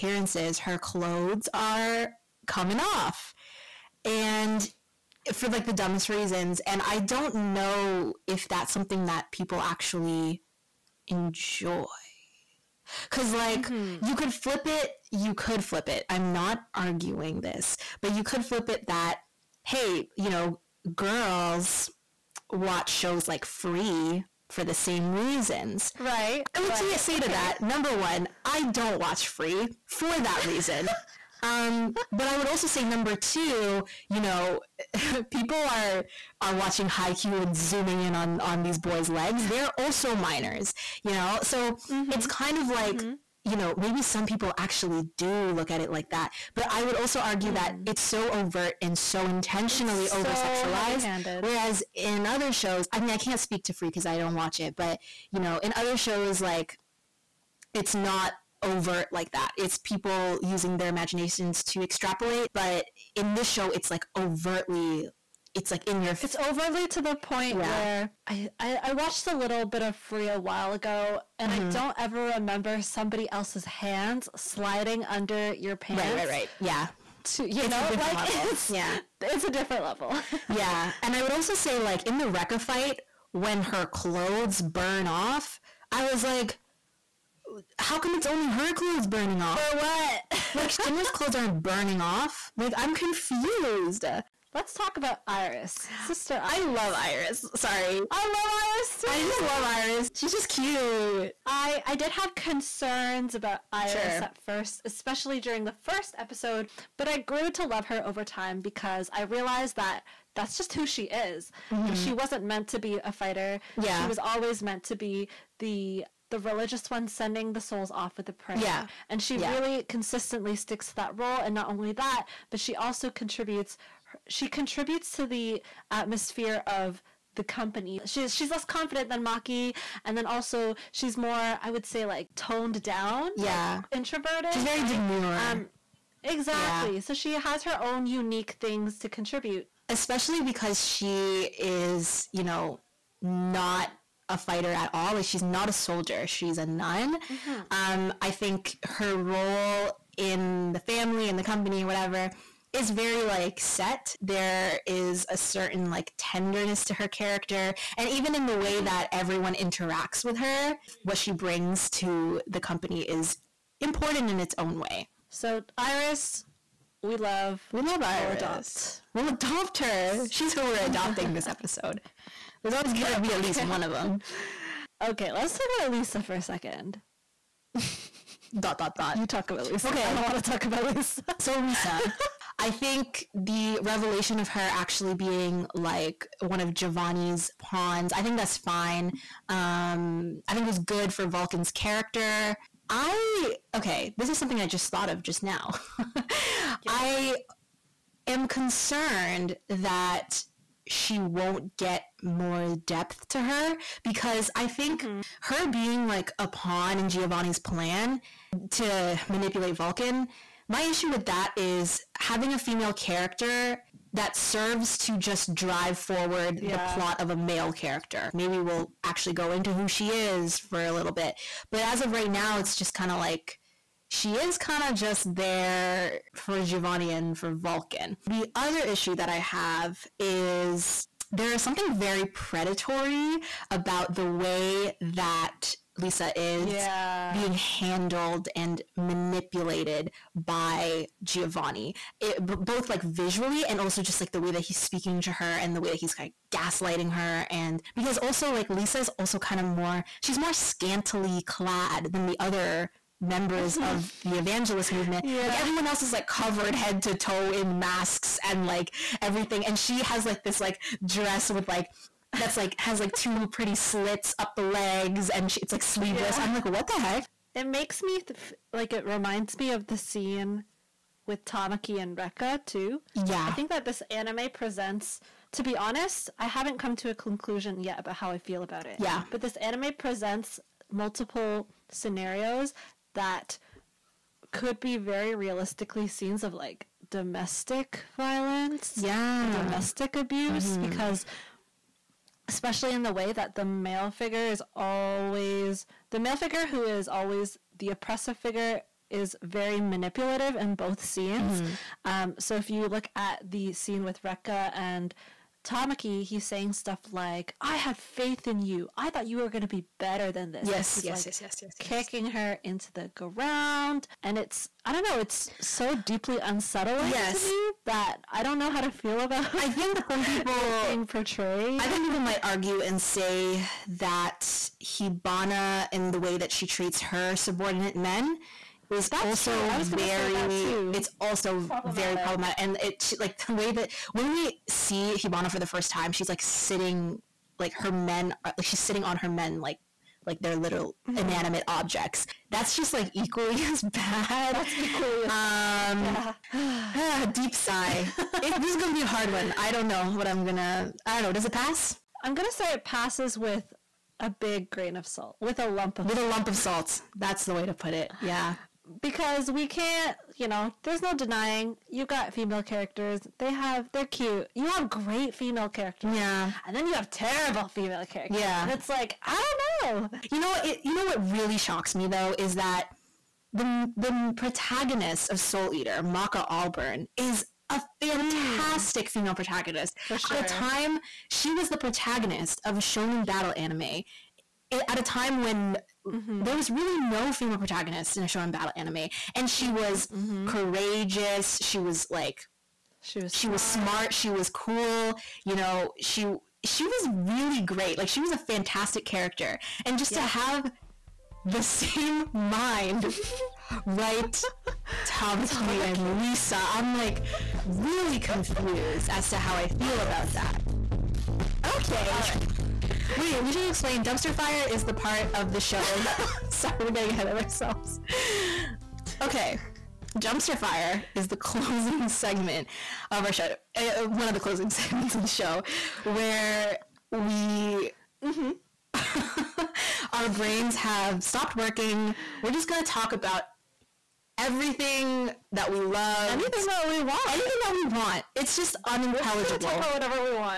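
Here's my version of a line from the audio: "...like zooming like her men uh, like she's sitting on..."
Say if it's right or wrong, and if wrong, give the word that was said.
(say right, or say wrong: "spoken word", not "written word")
wrong: "sitting", not "zooming".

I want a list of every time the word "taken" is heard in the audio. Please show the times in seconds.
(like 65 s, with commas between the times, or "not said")
not said.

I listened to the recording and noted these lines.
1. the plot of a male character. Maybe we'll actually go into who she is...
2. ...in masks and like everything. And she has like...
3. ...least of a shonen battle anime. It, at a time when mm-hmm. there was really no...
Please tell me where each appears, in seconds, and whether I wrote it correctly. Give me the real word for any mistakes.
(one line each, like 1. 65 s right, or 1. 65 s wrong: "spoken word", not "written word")
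1. 216 s right
2. 257 s right
3. 381 s wrong: "protagonist", not "least".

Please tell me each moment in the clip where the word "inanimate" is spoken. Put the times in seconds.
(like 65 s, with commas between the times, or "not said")
341 s.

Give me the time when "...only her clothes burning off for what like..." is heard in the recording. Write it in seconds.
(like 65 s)
88 s.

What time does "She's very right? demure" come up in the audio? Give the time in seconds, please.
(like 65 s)
134 s.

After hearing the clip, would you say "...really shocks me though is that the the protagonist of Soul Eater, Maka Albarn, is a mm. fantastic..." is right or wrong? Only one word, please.
right.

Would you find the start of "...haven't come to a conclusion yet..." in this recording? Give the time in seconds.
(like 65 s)
276 s.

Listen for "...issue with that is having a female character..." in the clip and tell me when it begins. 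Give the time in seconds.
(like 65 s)
210 s.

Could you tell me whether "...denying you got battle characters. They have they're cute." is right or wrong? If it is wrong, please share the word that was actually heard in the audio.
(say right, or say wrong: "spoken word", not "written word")
wrong: "female", not "battle".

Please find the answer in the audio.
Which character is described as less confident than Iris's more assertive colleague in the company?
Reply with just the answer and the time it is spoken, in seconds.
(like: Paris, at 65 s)
Maki, at 129 s.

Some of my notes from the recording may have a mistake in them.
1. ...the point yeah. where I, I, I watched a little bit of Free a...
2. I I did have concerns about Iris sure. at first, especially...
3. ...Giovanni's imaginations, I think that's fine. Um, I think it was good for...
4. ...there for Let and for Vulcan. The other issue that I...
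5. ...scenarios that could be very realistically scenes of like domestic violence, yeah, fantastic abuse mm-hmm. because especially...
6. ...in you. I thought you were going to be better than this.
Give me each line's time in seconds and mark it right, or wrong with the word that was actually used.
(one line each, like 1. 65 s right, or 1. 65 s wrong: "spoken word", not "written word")
1. 67 s right
2. 101 s right
3. 186 s wrong: "pawns", not "imaginations"
4. 225 s wrong: "Giovanni", not "Let"
5. 281 s wrong: "domestic", not "fantastic"
6. 308 s right.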